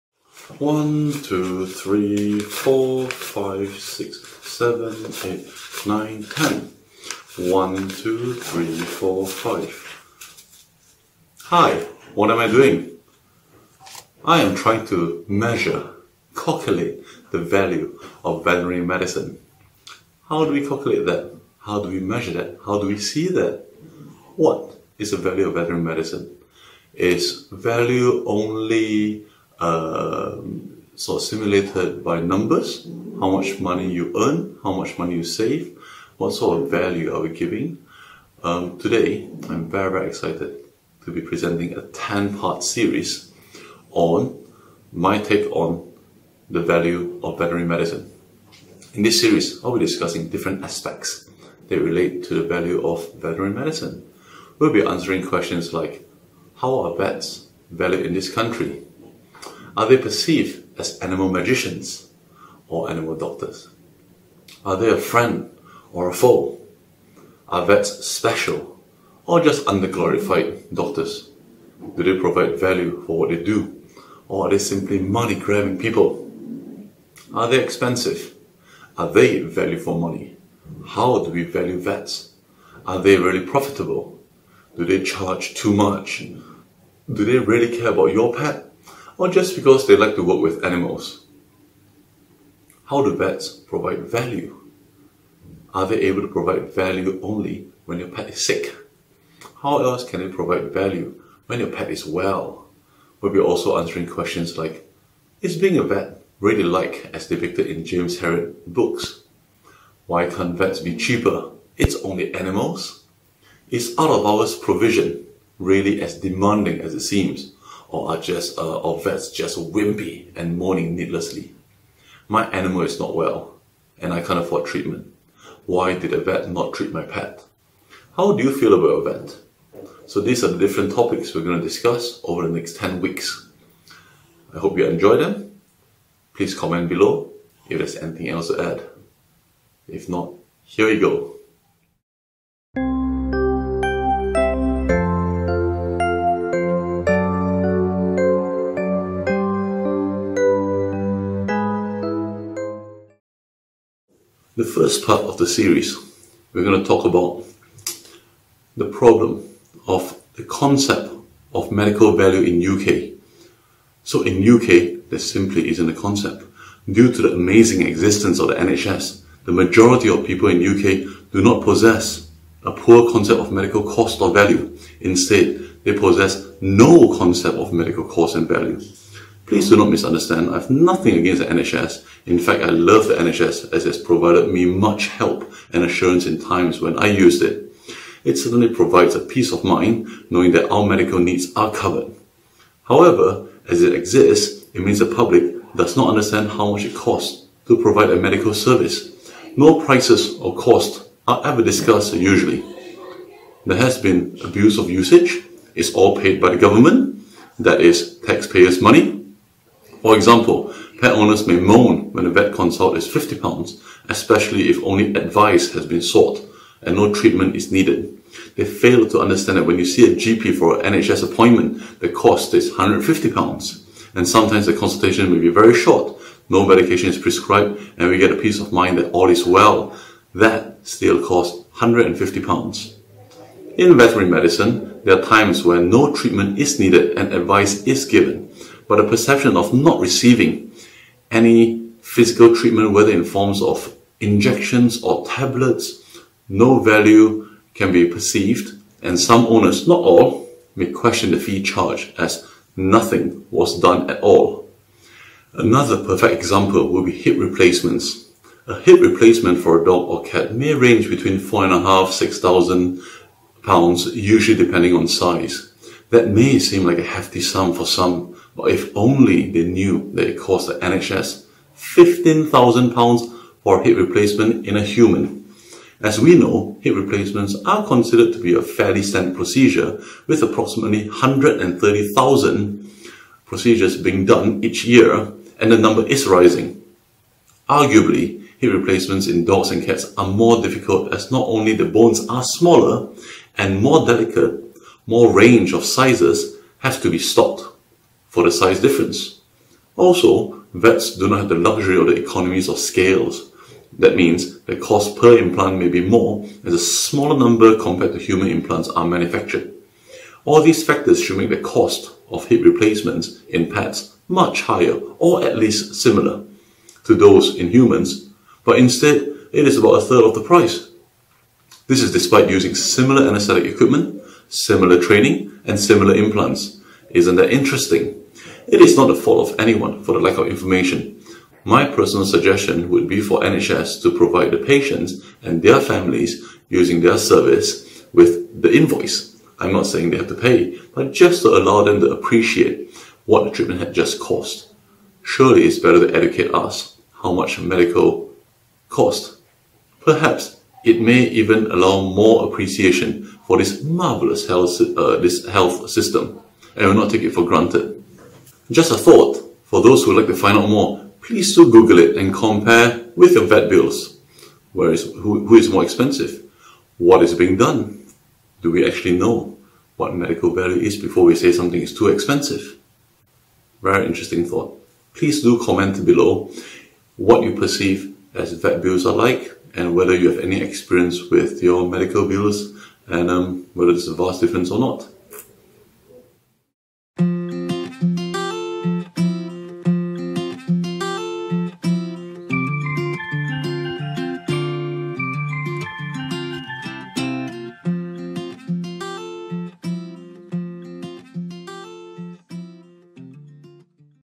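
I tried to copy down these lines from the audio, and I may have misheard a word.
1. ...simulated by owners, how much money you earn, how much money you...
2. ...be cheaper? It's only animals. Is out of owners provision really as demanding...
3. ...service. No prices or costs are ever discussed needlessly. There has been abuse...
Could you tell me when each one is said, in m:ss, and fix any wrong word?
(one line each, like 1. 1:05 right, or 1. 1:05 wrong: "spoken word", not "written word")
1. 0:31 wrong: "numbers", not "owners"
2. 1:50 wrong: "hours", not "owners"
3. 3:18 wrong: "usually", not "needlessly".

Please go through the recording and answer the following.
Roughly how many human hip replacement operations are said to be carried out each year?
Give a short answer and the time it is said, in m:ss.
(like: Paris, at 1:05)
130,000, at 4:41.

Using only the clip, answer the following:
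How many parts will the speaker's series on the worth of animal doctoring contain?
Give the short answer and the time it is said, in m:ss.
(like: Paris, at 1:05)
10, at 0:41.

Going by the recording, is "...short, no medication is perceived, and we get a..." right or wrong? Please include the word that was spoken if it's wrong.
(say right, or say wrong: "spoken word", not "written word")
wrong: "prescribed", not "perceived".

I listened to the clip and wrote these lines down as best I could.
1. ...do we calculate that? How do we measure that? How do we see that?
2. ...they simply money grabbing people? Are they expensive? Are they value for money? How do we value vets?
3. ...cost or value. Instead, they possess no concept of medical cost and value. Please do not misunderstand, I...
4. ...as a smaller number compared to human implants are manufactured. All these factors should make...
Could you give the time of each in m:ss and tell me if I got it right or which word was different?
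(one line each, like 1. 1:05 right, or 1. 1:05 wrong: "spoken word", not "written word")
1. 0:20 right
2. 1:14 right
3. 2:53 right
4. 5:06 right.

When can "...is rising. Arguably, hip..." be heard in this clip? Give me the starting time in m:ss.
4:46.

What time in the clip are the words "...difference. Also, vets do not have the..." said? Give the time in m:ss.
4:58.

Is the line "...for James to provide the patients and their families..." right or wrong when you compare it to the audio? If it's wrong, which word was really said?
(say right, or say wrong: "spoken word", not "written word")
wrong: "NHS", not "James".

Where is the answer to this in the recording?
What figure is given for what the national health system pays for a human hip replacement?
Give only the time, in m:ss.
4:31.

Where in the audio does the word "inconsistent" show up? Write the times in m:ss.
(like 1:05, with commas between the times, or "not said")
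not said.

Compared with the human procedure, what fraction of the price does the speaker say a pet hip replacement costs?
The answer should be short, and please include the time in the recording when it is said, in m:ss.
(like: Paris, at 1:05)
a third, at 5:19.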